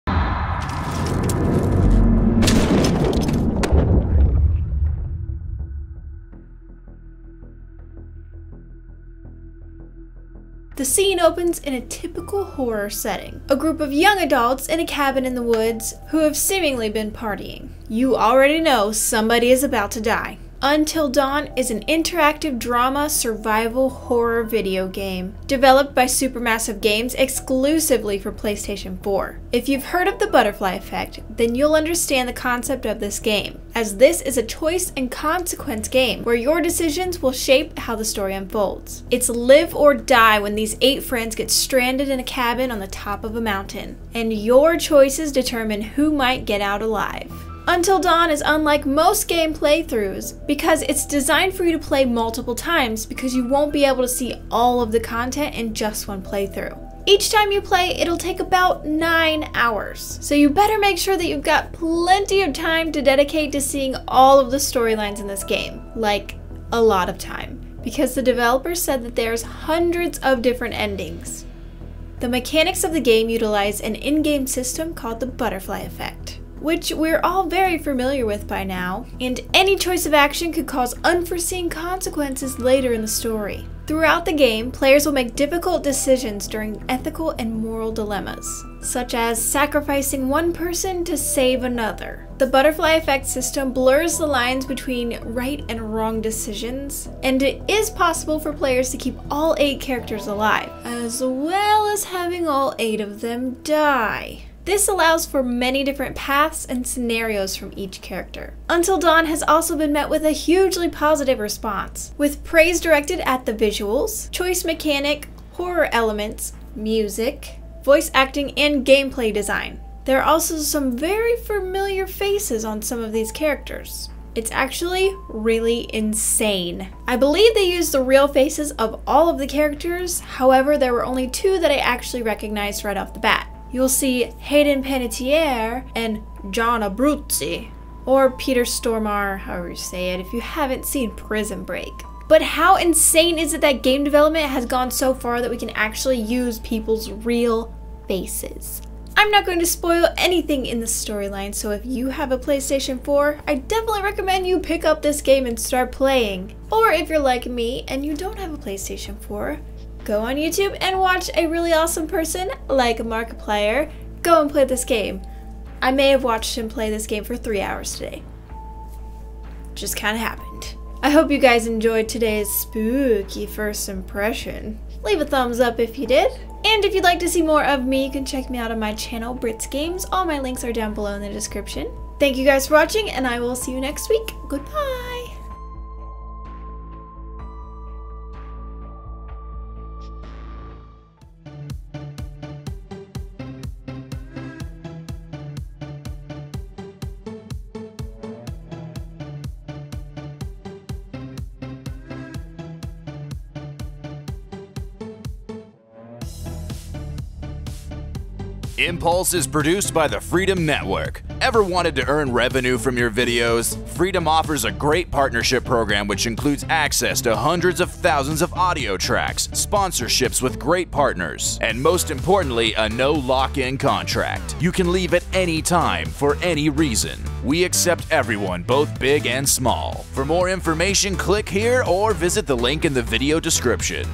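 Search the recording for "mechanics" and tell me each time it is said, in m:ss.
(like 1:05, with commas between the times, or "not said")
1:12, 1:54.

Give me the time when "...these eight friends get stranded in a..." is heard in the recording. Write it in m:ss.
0:40.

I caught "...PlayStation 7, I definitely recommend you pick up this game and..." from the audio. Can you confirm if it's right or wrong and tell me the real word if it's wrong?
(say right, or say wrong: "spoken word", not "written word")
wrong: "4", not "7".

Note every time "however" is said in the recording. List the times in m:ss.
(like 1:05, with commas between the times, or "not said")
2:10, 2:19.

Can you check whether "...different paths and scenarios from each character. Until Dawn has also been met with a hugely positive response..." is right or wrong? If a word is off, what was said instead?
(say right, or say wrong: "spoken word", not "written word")
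right.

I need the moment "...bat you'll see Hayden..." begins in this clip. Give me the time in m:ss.
2:13.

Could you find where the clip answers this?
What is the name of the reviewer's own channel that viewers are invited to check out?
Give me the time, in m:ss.
2:59.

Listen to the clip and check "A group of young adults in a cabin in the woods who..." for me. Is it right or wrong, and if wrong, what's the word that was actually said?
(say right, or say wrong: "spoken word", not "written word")
right.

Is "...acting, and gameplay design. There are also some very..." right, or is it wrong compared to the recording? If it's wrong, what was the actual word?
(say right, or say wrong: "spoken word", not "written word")
right.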